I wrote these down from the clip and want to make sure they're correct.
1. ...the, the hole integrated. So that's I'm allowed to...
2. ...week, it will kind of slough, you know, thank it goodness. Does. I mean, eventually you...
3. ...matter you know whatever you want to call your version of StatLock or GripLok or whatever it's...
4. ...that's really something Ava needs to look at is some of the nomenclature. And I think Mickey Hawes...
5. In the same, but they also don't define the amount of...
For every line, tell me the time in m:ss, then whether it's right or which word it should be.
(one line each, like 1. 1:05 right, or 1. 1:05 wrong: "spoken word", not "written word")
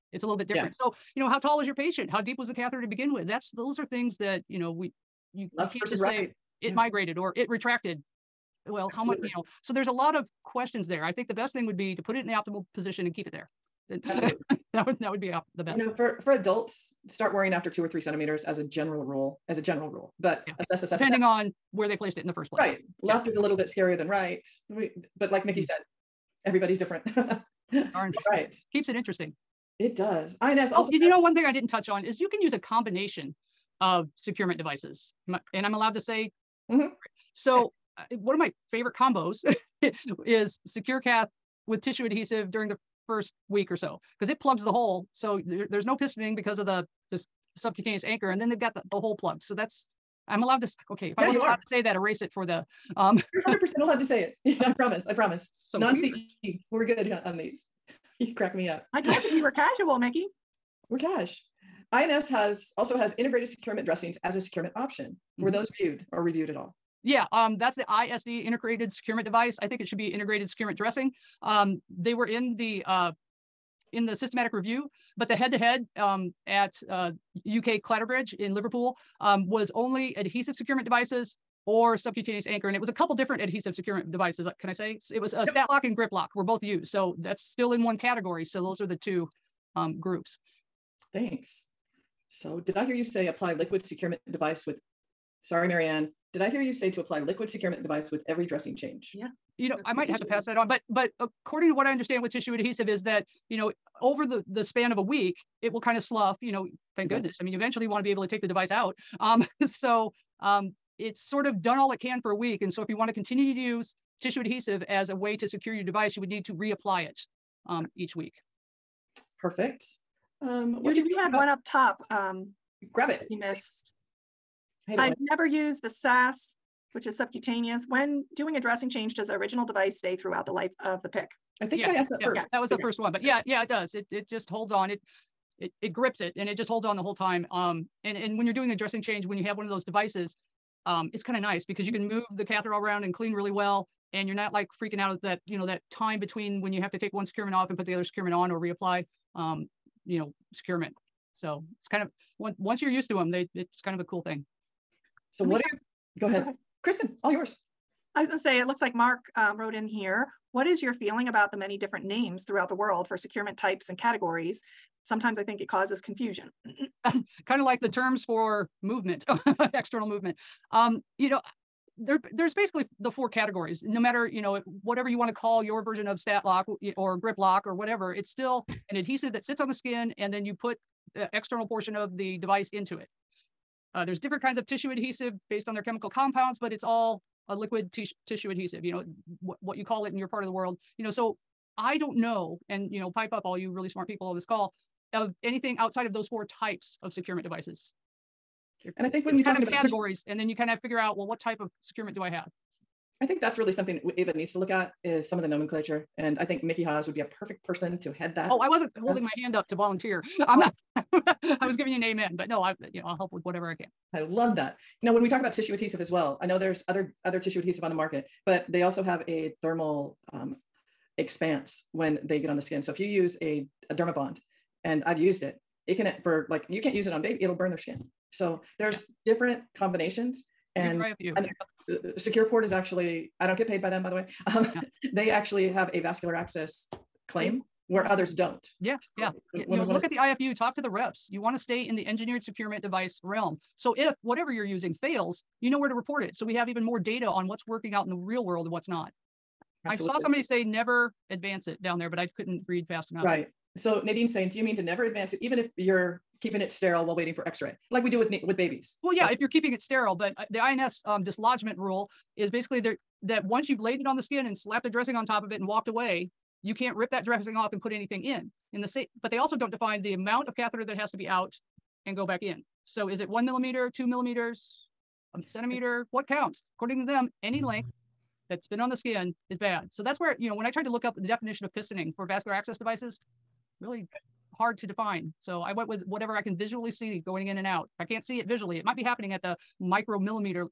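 1. 0:48 wrong: "plugged", not "integrated"
2. 1:45 right
3. 2:53 right
4. 3:23 right
5. 4:28 right.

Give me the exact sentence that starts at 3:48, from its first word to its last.
So there's different combinations and, and uh, SecurePort is actually, I don't get paid by them, by the way.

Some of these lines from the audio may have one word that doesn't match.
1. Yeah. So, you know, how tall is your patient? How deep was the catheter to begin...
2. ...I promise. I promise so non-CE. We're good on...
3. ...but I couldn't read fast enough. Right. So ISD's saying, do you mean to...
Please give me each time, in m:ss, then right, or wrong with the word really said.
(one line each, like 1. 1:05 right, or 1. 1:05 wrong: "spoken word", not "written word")
1. 0:00 right
2. 0:54 right
3. 4:12 wrong: "Nadine", not "ISD".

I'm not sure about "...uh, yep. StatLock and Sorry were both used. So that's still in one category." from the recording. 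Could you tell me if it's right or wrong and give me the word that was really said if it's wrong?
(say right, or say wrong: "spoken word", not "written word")
wrong: "GripLok", not "Sorry".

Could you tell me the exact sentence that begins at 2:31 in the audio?
So it's kind of once once you're used to them, they it's kind of a cool thing.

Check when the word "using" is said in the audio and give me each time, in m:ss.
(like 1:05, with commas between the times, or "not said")
4:04.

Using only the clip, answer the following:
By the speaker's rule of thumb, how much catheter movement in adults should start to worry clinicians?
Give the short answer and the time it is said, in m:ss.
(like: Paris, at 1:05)
2 or 3 centimeters, at 0:17.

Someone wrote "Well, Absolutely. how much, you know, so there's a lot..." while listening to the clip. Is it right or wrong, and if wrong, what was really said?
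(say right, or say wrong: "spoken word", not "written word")
right.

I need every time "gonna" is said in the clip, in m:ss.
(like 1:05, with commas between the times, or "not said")
2:38.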